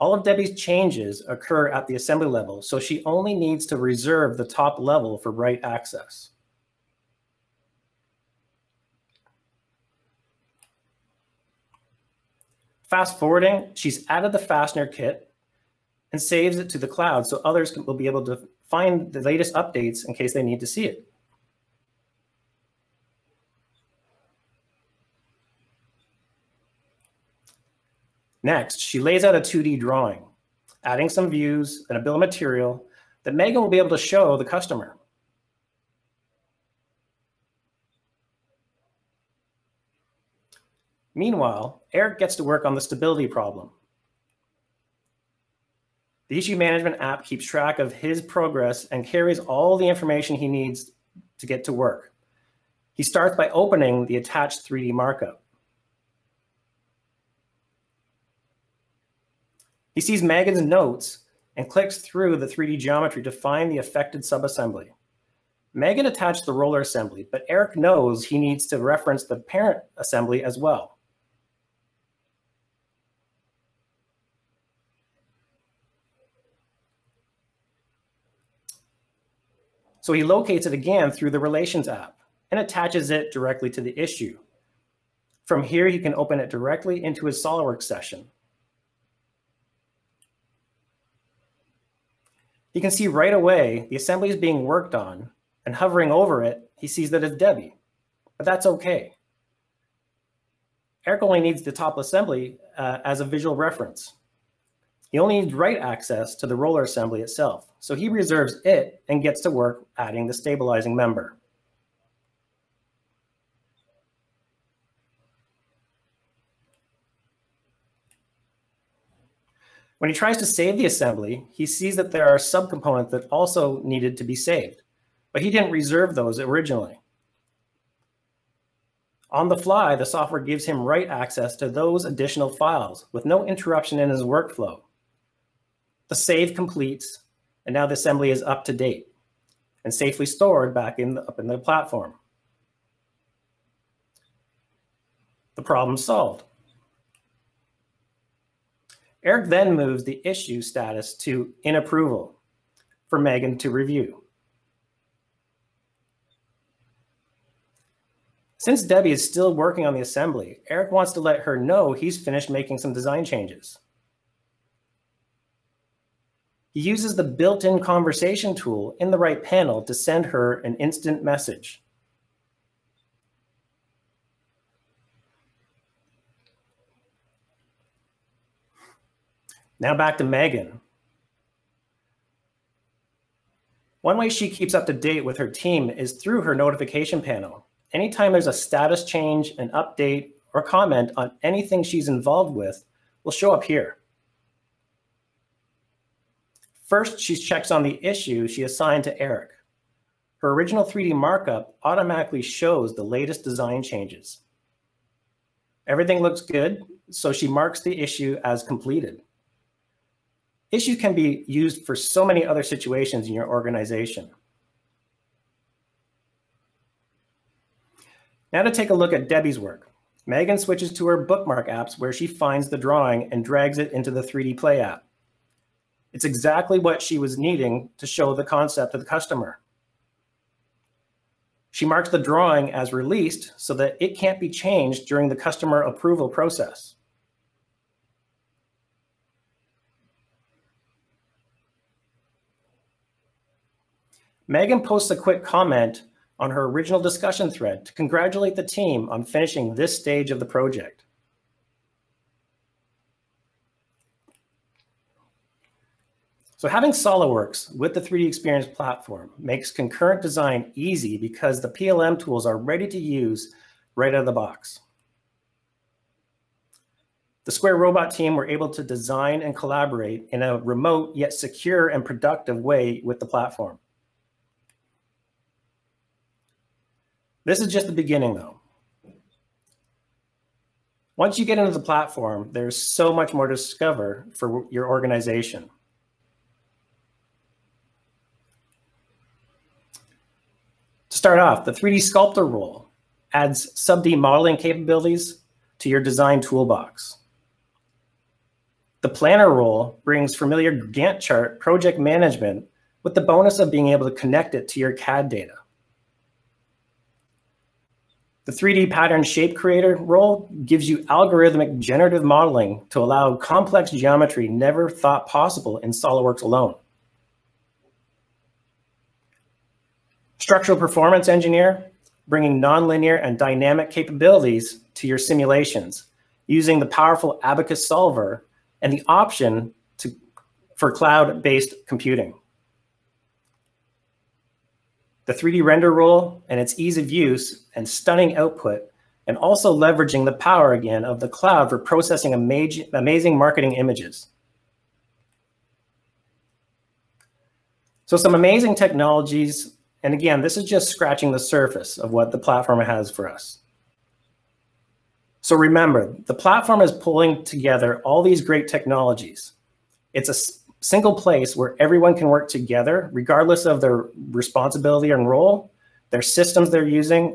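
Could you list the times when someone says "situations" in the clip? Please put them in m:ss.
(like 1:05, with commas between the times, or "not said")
3:32.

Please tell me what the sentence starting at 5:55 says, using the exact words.
So remember, the platform is pulling together all these great technologies.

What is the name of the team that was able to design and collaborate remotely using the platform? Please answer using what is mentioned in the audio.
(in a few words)
Square Robot.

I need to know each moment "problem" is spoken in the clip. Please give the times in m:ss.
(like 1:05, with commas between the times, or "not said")
0:43, 2:25.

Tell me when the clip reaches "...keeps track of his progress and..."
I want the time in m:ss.
0:47.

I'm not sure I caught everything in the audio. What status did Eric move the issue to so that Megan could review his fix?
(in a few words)
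in approval.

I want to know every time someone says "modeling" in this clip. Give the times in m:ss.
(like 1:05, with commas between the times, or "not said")
4:54, 5:12.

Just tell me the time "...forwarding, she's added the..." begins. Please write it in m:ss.
0:13.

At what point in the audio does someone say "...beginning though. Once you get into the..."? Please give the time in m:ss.
4:37.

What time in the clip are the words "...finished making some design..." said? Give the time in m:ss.
2:42.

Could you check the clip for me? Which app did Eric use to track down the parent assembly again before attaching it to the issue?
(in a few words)
Relations app.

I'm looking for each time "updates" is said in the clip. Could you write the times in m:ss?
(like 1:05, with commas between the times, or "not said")
0:19, 3:09.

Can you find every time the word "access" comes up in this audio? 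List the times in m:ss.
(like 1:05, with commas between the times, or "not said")
0:05, 1:45, 2:11.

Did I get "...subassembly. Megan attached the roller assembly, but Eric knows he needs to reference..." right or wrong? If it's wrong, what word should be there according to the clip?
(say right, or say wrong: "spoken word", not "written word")
right.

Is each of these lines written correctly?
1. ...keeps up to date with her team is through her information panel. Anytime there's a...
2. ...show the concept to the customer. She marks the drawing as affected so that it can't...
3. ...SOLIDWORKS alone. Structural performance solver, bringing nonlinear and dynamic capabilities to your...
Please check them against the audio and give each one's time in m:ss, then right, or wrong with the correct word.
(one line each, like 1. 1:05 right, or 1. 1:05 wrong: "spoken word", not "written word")
1. 3:04 wrong: "notification", not "information"
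2. 3:48 wrong: "released", not "affected"
3. 5:15 wrong: "engineer", not "solver".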